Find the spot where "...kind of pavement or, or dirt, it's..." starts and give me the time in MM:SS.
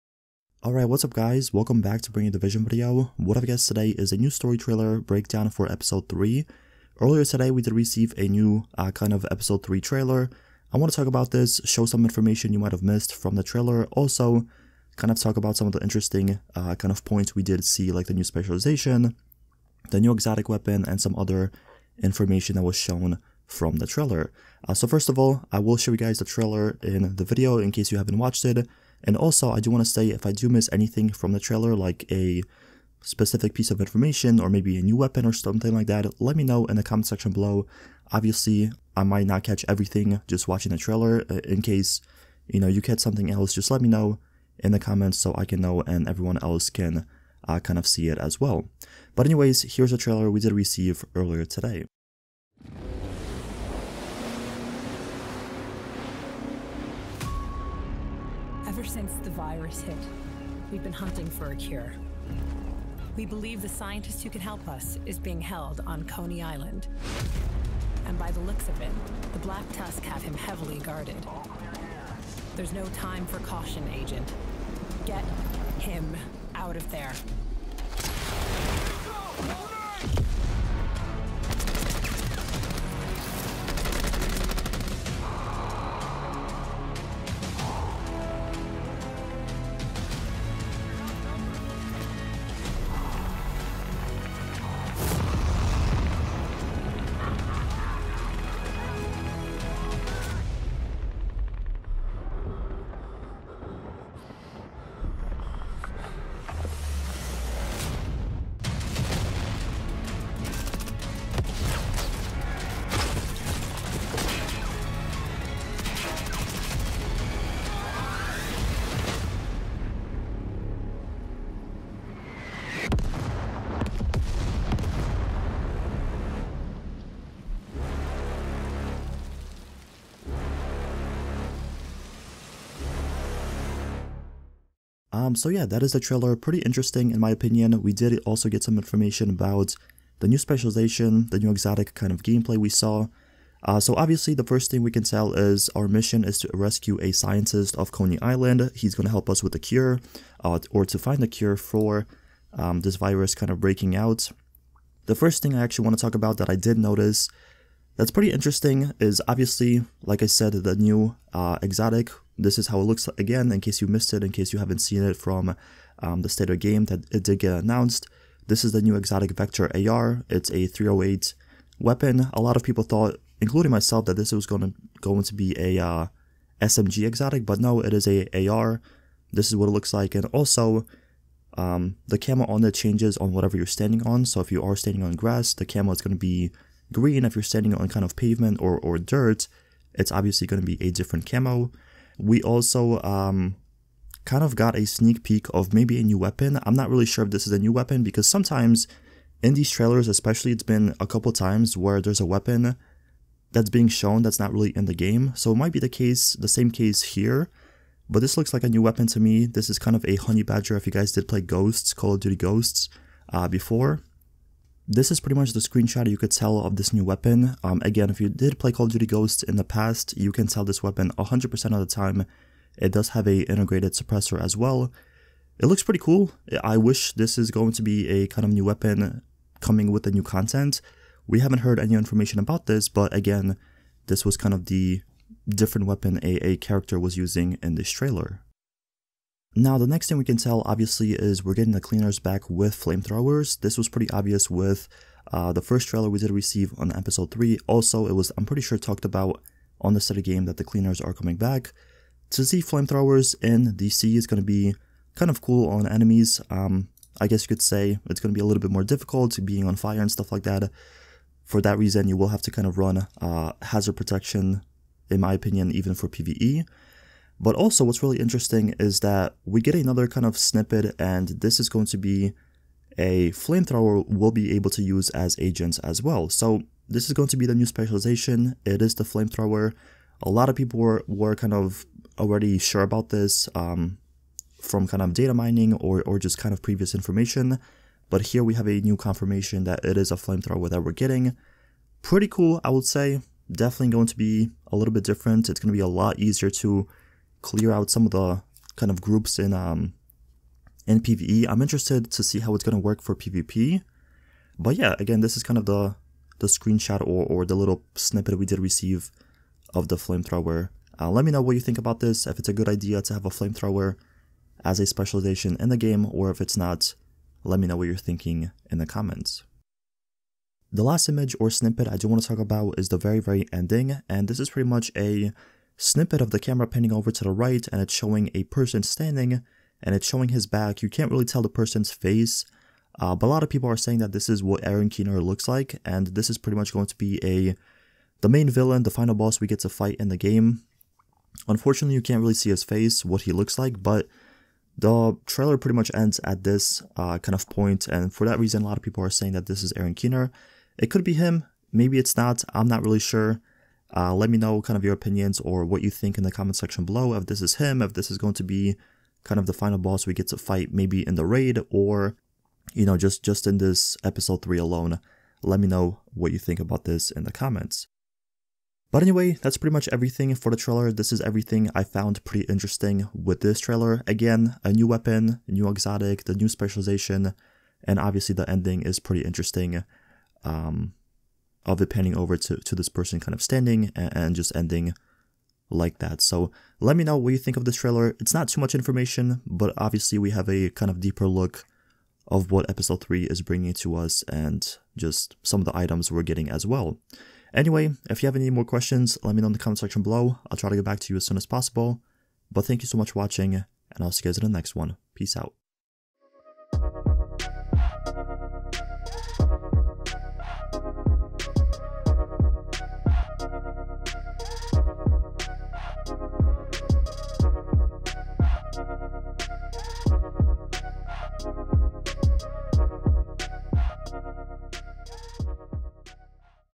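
03:07.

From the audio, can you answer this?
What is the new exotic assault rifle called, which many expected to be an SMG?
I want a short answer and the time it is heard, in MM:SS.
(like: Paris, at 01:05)
Vector, at 02:49.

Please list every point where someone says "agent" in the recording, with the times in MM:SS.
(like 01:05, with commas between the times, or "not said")
01:13, 04:35.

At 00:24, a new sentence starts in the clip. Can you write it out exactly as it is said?
Uh, so first of all, I will show you guys the trailer in the video in case you haven't watched it.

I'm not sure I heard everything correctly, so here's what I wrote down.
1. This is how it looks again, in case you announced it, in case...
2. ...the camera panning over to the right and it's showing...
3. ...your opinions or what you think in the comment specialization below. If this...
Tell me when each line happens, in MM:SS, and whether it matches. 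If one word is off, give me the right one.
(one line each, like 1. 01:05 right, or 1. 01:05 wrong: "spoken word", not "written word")
1. 02:42 wrong: "missed", not "announced"
2. 05:26 right
3. 05:54 wrong: "section", not "specialization".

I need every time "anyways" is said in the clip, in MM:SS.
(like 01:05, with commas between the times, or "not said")
00:49, 06:09, 06:37.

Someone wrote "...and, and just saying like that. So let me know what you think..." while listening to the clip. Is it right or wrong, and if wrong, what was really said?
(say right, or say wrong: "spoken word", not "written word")
wrong: "ending", not "saying".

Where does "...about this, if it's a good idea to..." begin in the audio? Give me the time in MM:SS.
05:11.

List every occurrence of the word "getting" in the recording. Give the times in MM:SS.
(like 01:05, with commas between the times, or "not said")
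04:01, 04:50, 06:36.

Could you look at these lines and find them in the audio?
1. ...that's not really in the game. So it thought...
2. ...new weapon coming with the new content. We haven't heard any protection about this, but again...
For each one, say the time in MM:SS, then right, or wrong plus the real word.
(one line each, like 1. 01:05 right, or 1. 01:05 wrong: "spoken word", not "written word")
1. 03:24 wrong: "might", not "thought"
2. 03:48 wrong: "information", not "protection".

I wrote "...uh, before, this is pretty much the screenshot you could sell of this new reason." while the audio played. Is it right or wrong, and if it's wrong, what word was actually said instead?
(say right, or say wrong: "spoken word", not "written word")
wrong: "weapon", not "reason".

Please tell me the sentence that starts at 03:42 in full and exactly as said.
It does have a integrated suppressor as well.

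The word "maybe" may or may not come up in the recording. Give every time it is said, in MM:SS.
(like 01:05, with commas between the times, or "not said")
00:34, 03:15, 05:51, 06:00.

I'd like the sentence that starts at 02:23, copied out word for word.
Uh, so obviously the first thing we can tell is our mission is to rescue a scientist of Coney Island.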